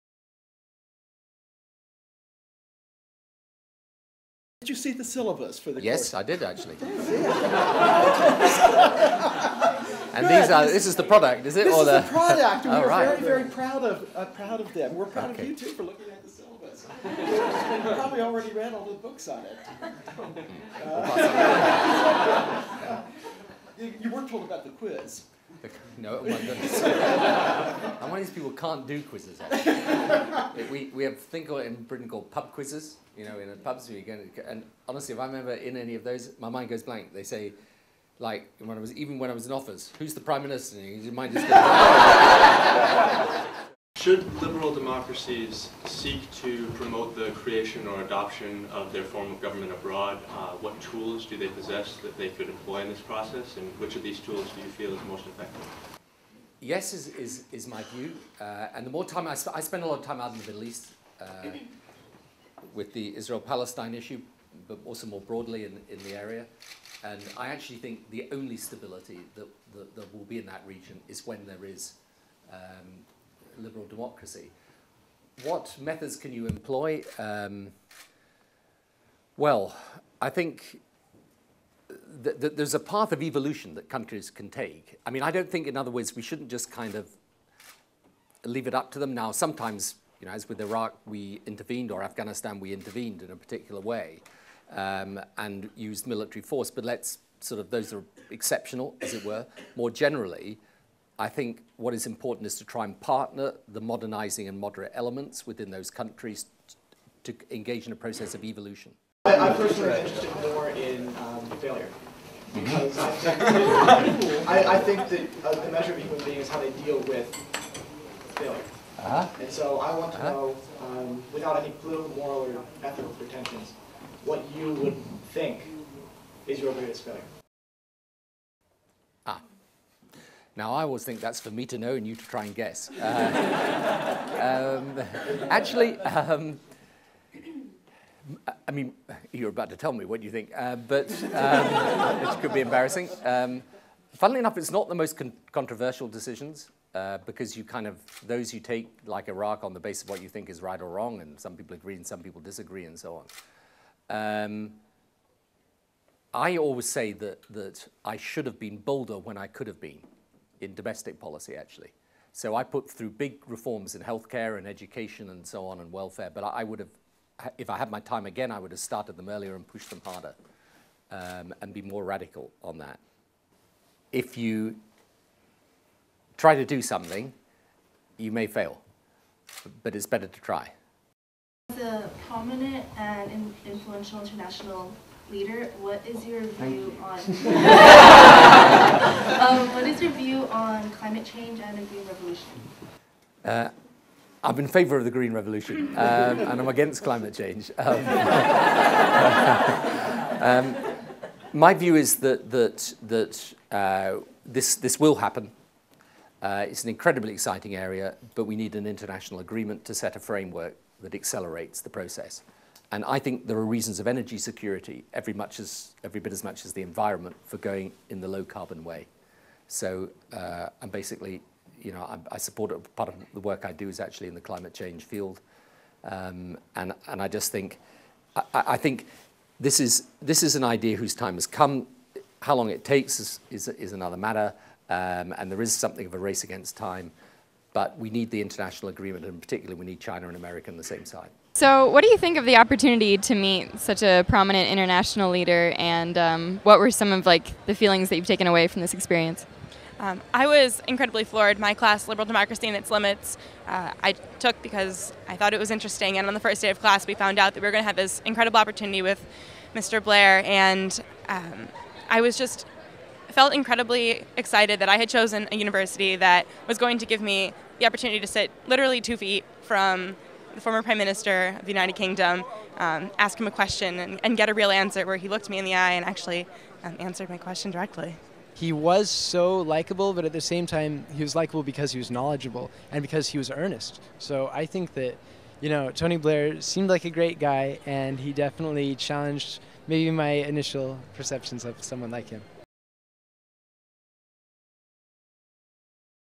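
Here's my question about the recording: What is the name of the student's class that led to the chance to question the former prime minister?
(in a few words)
Liberal Democracy and Its Limits.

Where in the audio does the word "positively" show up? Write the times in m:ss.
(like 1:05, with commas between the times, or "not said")
not said.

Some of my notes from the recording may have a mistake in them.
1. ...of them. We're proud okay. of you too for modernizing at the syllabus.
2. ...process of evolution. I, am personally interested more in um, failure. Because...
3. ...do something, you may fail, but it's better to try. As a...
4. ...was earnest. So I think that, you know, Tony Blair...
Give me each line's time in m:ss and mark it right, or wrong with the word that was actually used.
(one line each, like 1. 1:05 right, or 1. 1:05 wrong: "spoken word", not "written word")
1. 0:14 wrong: "looking", not "modernizing"
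2. 1:47 right
3. 2:56 right
4. 4:43 right.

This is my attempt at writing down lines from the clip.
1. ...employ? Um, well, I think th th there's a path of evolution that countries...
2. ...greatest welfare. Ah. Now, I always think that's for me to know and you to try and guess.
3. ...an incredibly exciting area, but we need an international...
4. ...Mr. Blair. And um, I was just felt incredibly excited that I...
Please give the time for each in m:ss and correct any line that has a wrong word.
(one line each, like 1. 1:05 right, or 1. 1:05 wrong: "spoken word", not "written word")
1. 1:16 right
2. 2:06 wrong: "failure", not "welfare"
3. 3:26 right
4. 4:19 right.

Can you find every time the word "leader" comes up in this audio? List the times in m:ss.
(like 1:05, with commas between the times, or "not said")
3:05, 4:05.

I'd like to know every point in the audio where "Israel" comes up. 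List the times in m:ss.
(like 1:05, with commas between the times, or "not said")
1:03.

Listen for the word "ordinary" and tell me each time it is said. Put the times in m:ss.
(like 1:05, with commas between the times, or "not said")
not said.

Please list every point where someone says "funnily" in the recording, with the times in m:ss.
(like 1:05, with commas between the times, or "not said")
2:24.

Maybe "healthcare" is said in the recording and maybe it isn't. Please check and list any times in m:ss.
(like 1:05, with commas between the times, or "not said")
2:44.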